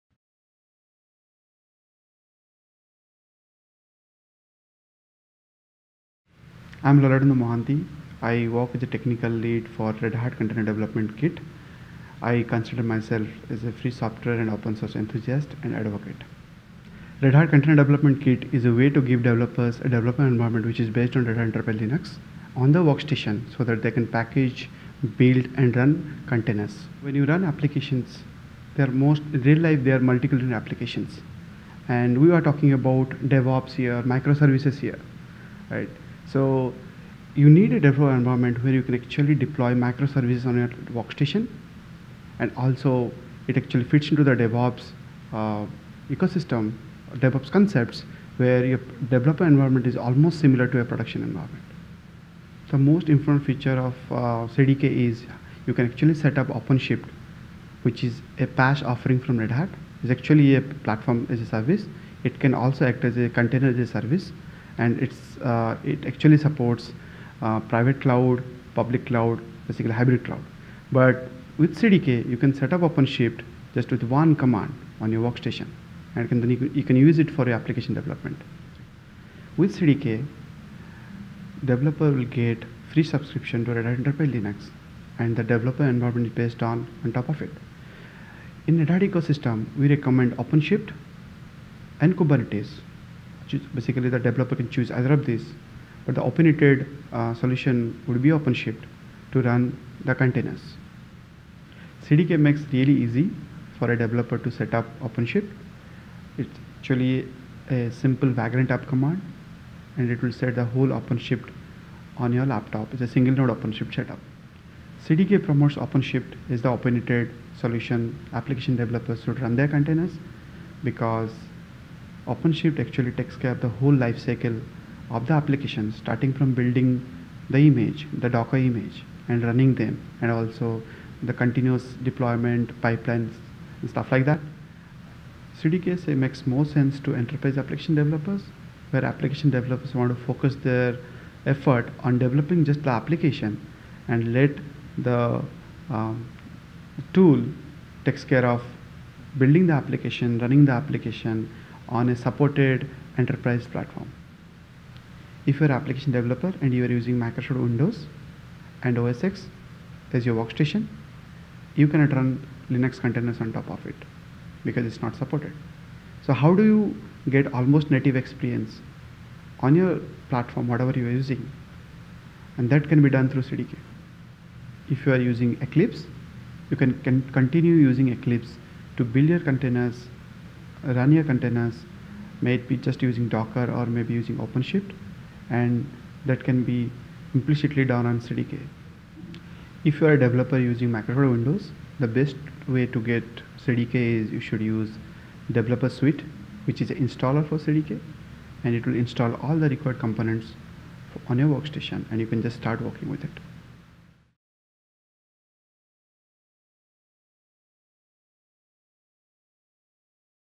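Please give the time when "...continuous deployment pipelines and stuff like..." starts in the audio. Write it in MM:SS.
02:11.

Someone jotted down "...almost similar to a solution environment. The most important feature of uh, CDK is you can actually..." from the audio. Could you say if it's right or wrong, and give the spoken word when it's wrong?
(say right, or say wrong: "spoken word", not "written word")
wrong: "production", not "solution".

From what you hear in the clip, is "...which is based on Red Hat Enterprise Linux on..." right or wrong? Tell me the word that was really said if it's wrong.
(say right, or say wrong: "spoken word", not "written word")
right.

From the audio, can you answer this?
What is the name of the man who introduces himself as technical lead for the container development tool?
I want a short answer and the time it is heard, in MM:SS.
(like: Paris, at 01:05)
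Lalatendu Mohanti, at 00:06.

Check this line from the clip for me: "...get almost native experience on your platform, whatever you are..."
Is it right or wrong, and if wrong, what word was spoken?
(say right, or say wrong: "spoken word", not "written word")
right.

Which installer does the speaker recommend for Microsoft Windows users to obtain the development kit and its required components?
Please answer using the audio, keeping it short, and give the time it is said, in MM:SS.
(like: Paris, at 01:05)
Developer Suite, at 03:15.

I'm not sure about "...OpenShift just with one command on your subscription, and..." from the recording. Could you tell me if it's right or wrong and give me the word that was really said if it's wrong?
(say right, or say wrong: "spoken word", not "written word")
wrong: "workstation", not "subscription".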